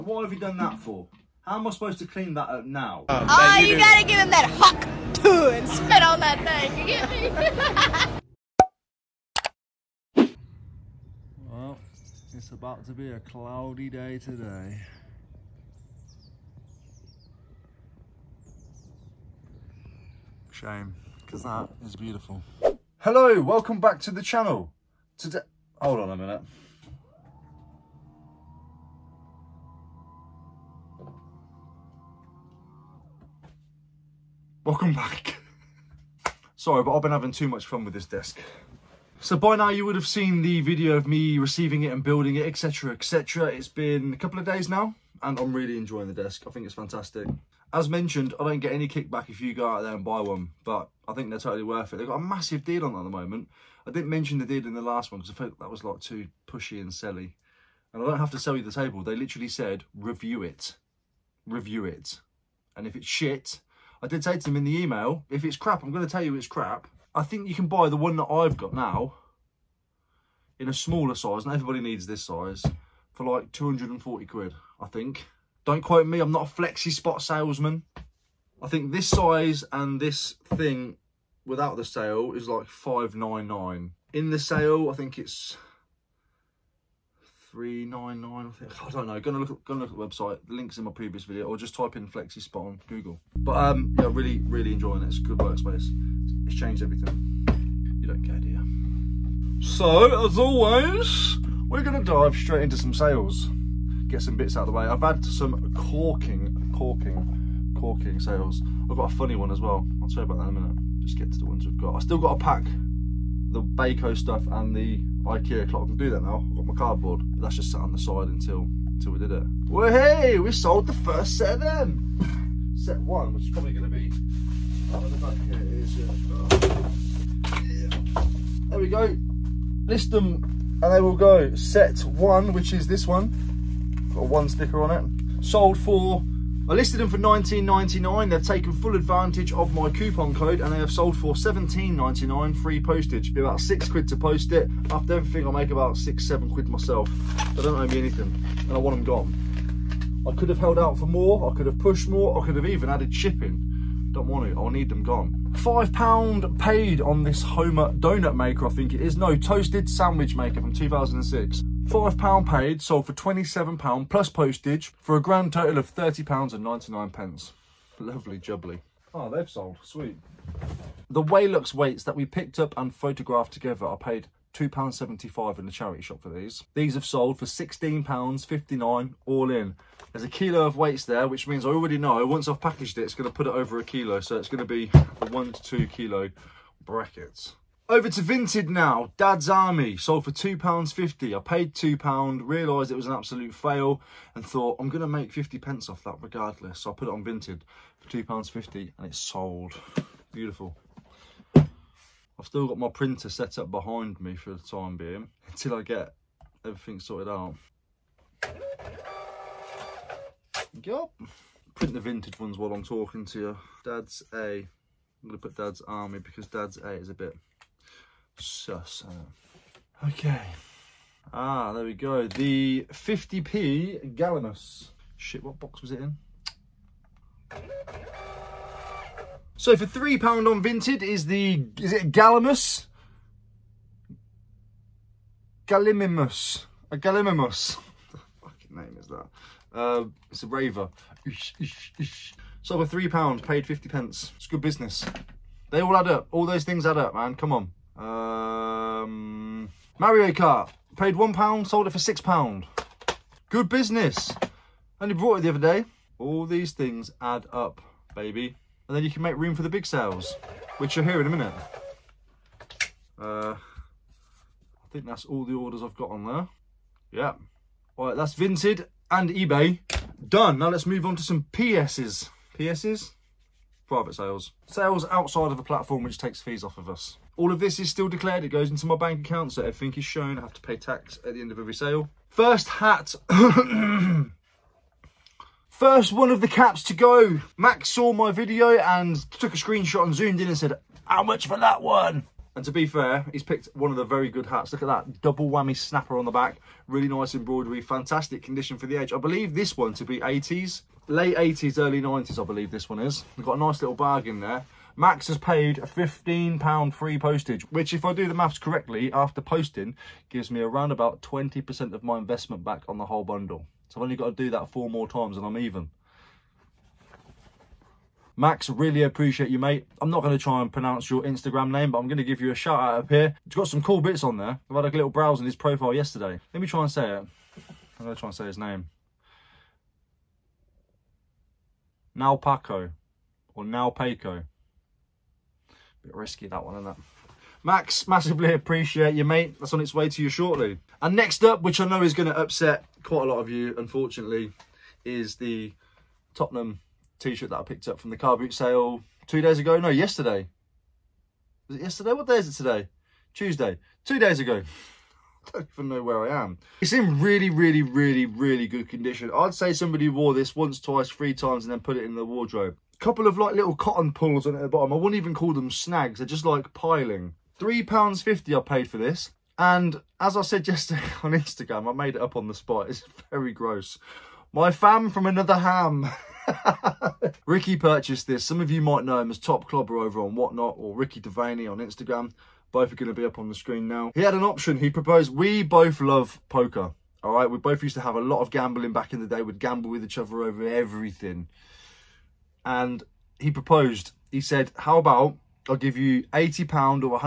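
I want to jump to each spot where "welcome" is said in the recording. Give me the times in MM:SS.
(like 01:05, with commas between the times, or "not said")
00:23, 00:34.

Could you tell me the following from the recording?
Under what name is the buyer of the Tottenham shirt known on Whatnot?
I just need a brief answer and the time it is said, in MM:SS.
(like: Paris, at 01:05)
Top Clobber, at 06:19.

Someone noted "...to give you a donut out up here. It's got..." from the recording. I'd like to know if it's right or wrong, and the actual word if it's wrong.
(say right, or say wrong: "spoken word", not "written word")
wrong: "shout", not "donut".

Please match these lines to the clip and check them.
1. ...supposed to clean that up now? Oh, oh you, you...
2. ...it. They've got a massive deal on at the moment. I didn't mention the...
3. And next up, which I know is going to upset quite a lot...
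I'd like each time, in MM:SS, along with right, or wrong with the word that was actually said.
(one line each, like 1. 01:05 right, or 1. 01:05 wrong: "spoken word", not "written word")
1. 00:01 right
2. 00:51 right
3. 05:41 right.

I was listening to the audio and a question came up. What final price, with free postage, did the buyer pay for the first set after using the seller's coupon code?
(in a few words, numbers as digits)
£17.99.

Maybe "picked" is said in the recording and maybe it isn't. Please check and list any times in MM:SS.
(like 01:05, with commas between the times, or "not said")
02:52, 04:53, 05:47.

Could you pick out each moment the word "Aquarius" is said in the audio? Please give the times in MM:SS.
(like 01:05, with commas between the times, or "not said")
not said.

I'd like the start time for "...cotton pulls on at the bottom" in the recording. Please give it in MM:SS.
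06:03.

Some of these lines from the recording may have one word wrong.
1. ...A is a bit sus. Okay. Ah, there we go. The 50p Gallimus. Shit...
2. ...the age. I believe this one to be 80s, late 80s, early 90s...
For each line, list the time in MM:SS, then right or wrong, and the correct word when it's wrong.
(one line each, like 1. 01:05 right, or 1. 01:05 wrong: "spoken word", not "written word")
1. 03:36 right
2. 04:58 right.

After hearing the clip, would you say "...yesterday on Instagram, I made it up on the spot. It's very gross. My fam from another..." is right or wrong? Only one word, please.
right.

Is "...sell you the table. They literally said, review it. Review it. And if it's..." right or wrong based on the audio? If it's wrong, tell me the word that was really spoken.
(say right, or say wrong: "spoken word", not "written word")
right.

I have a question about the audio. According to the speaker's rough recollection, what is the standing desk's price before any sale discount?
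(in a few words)
599.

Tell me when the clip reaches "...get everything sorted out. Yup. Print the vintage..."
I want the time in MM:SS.
03:25.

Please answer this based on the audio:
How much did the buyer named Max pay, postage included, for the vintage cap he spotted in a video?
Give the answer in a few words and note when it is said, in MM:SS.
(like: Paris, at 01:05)
£15, at 05:05.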